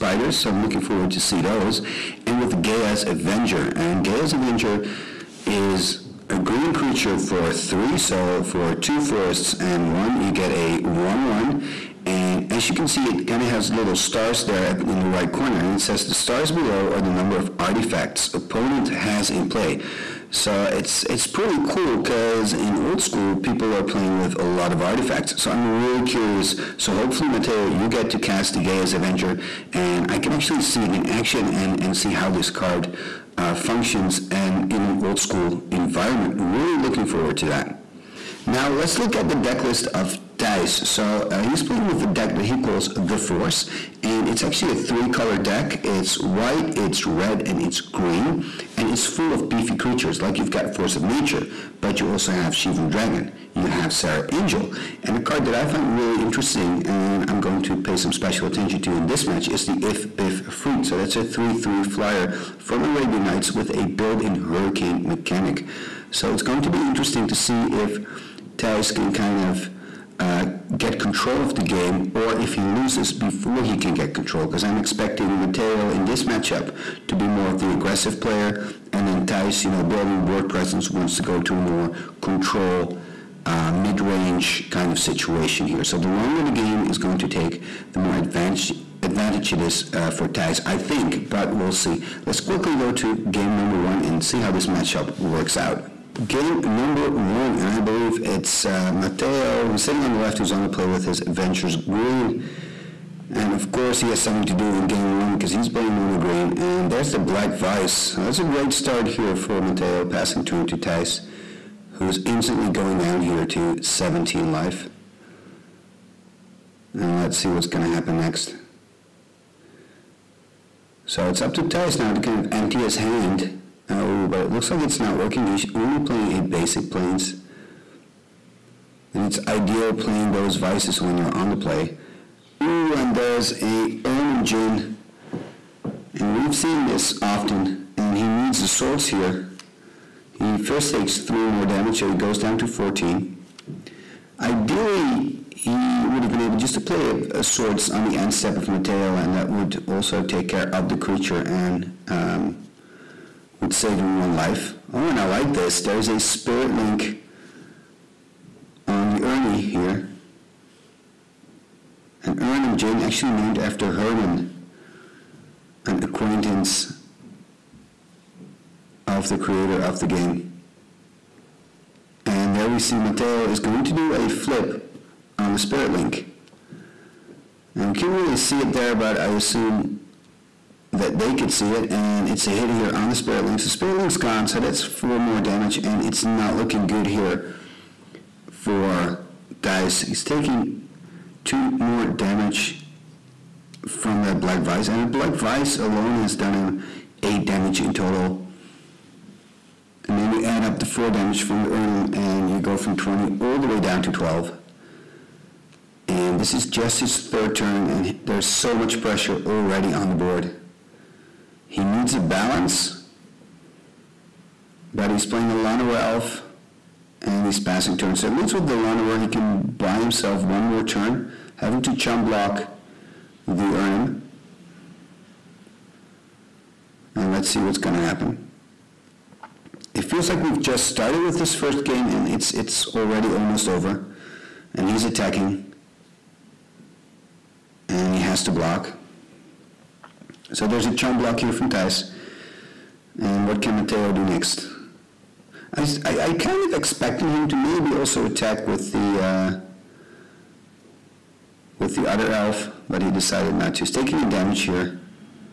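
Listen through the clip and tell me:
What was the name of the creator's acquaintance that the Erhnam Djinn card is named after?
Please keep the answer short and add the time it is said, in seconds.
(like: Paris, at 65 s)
Herman, at 163 s.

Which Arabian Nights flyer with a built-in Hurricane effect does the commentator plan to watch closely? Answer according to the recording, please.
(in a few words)
Ifh-Biff Efreet.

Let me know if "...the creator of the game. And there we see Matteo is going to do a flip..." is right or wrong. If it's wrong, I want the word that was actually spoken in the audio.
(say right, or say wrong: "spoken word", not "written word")
right.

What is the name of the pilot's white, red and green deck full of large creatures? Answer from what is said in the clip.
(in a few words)
The Force.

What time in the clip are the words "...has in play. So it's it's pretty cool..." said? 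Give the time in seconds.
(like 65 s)
18 s.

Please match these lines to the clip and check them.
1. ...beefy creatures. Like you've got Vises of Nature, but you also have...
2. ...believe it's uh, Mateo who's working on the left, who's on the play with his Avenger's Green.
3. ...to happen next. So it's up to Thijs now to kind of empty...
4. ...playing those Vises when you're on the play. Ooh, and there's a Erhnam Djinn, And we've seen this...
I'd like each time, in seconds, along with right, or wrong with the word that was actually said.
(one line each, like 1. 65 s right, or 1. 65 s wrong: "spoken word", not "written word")
1. 49 s wrong: "Force", not "Vises"
2. 97 s wrong: "sitting", not "working"
3. 117 s right
4. 129 s right.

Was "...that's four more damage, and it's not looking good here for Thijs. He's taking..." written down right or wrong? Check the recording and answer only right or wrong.
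right.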